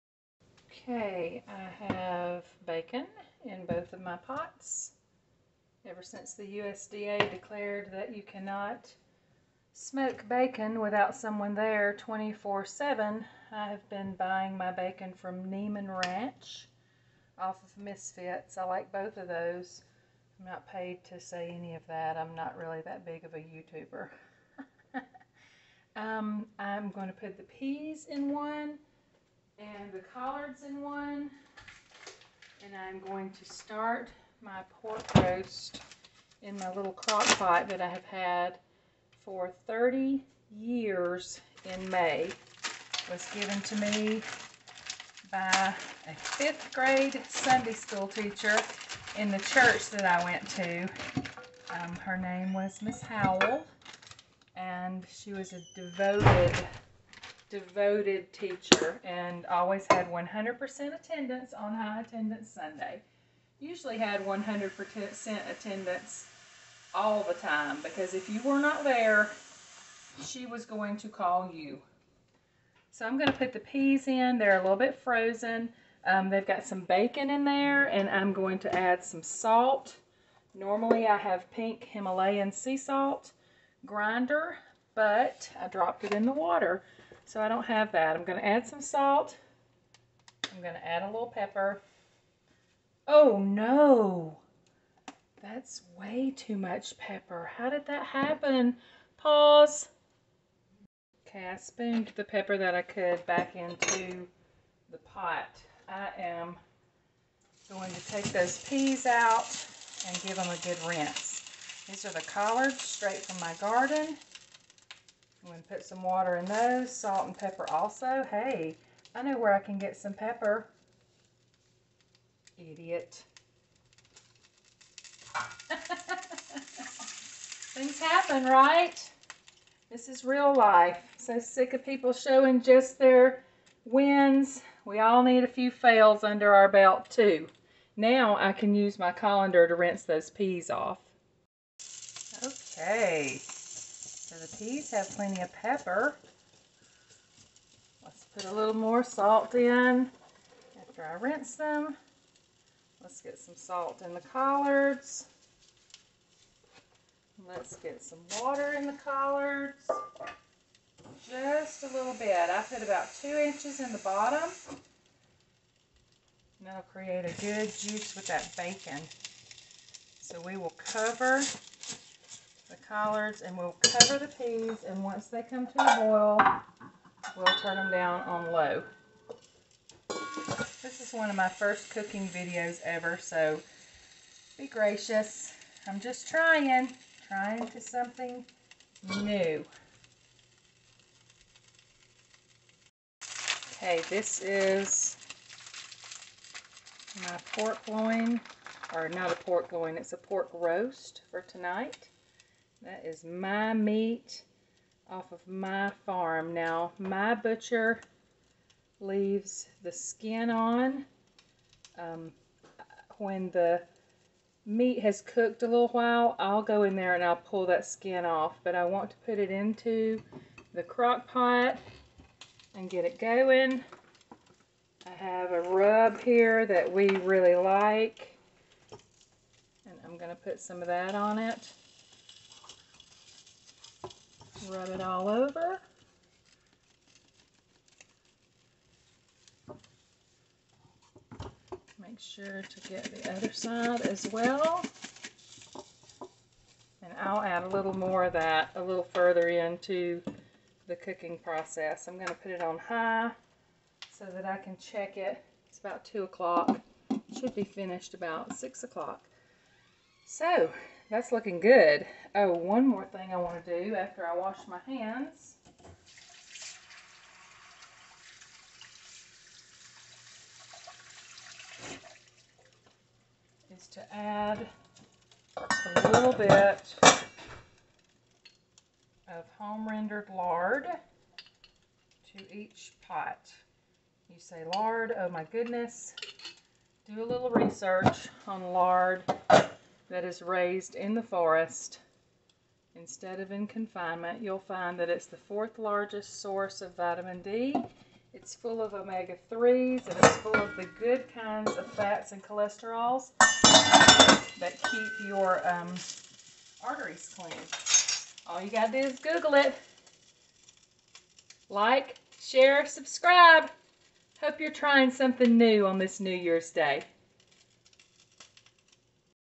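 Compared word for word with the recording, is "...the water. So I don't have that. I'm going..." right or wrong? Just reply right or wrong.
right.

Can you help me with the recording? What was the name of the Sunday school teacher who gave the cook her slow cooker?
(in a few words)
Miss Howell.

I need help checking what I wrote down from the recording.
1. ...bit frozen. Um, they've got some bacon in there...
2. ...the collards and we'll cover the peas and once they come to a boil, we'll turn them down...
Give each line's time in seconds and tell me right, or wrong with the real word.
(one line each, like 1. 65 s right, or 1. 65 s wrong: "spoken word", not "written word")
1. 74 s right
2. 172 s right.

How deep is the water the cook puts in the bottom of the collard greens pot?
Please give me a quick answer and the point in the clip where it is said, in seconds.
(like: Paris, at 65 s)
2 inches, at 163 s.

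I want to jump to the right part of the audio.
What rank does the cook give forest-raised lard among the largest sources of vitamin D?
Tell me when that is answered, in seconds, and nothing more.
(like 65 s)
295 s.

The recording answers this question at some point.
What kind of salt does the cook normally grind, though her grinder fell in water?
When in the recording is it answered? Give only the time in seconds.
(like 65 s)
81 s.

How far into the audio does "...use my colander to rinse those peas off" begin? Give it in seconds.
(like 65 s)
138 s.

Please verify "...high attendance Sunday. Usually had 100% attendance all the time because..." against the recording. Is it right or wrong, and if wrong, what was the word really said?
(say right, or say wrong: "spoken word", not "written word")
right.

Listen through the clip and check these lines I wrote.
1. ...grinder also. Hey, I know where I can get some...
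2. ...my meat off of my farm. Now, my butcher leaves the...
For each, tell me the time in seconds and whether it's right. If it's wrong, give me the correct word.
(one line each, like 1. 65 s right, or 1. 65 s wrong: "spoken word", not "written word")
1. 117 s wrong: "pepper", not "grinder"
2. 203 s right.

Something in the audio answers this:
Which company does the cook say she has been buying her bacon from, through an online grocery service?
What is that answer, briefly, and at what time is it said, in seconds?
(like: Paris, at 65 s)
Niman Ranch, at 15 s.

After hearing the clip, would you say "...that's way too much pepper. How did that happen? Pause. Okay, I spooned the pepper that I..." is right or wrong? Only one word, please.
right.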